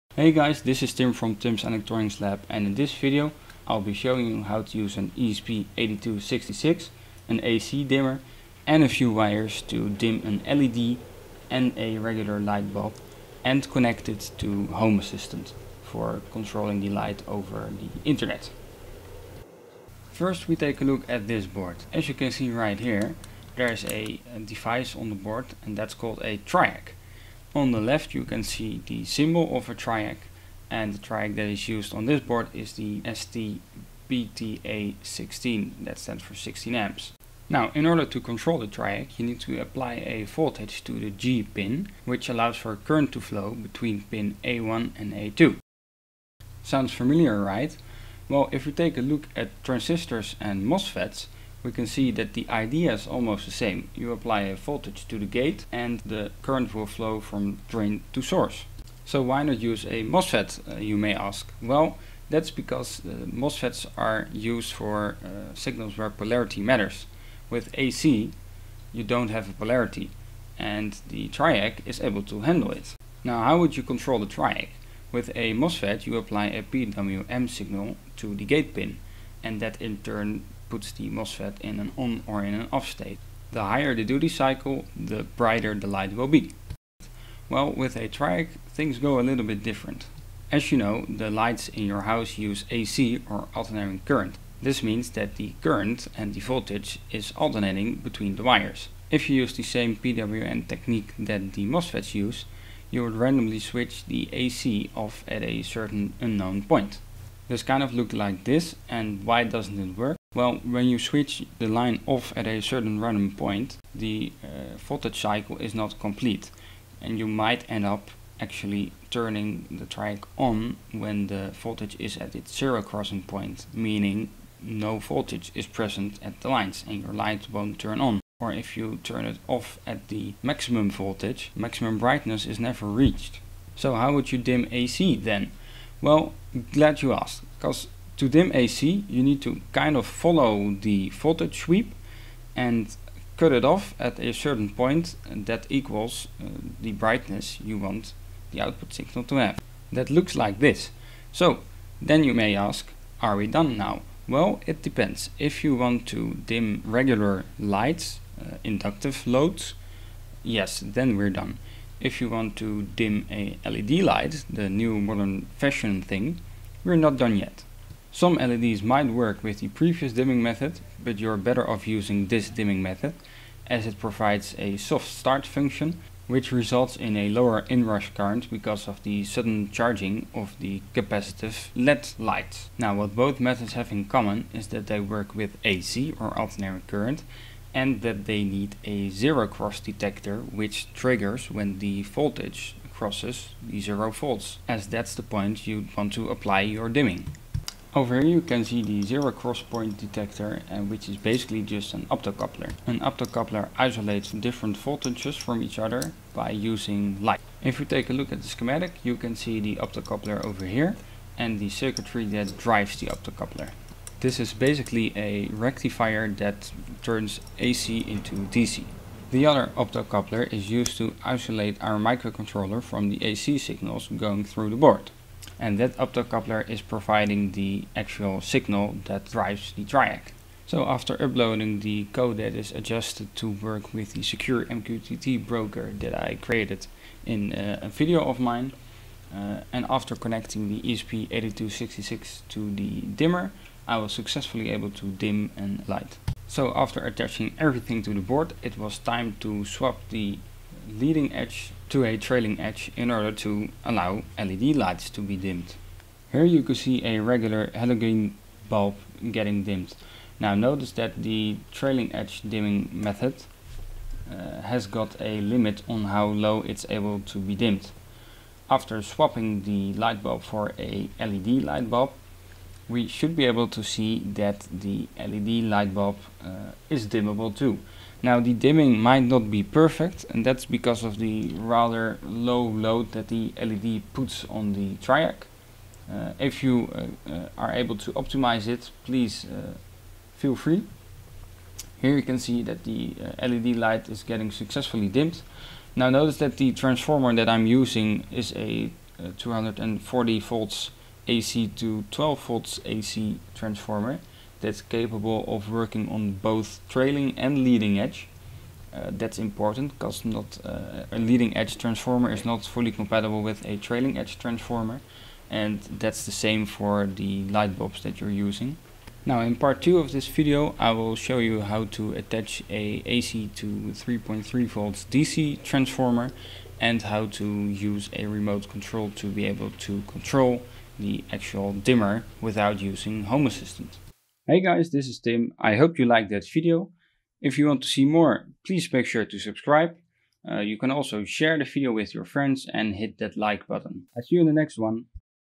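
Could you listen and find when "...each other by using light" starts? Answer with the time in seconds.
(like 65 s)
205 s.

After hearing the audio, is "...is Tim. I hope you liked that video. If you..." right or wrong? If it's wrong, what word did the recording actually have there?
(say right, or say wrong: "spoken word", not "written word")
right.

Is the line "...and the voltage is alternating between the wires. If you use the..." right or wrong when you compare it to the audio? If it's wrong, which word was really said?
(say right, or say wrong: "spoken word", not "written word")
right.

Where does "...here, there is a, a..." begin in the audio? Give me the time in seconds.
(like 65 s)
22 s.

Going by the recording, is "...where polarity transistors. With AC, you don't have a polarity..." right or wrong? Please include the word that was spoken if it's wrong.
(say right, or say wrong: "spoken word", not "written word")
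wrong: "matters", not "transistors".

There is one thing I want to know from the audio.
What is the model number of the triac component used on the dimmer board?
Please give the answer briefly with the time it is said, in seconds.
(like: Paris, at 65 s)
STBTA16, at 33 s.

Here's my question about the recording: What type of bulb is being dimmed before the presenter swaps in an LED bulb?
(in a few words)
halogen.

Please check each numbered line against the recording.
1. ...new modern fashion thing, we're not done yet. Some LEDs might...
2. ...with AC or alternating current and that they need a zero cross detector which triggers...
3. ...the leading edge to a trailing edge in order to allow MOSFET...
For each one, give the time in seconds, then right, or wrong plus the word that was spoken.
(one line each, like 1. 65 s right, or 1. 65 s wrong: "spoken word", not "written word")
1. 164 s right
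2. 185 s right
3. 250 s wrong: "LED", not "MOSFET".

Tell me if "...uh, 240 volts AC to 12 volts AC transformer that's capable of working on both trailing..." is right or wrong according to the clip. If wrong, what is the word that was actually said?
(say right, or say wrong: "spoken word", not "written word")
right.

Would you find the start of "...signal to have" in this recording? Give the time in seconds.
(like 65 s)
148 s.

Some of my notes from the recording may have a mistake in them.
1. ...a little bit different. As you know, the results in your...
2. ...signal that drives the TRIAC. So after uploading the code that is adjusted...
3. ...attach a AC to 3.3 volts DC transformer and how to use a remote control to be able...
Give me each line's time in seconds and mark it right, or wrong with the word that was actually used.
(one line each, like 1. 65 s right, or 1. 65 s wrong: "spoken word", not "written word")
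1. 89 s wrong: "lights", not "results"
2. 228 s right
3. 322 s right.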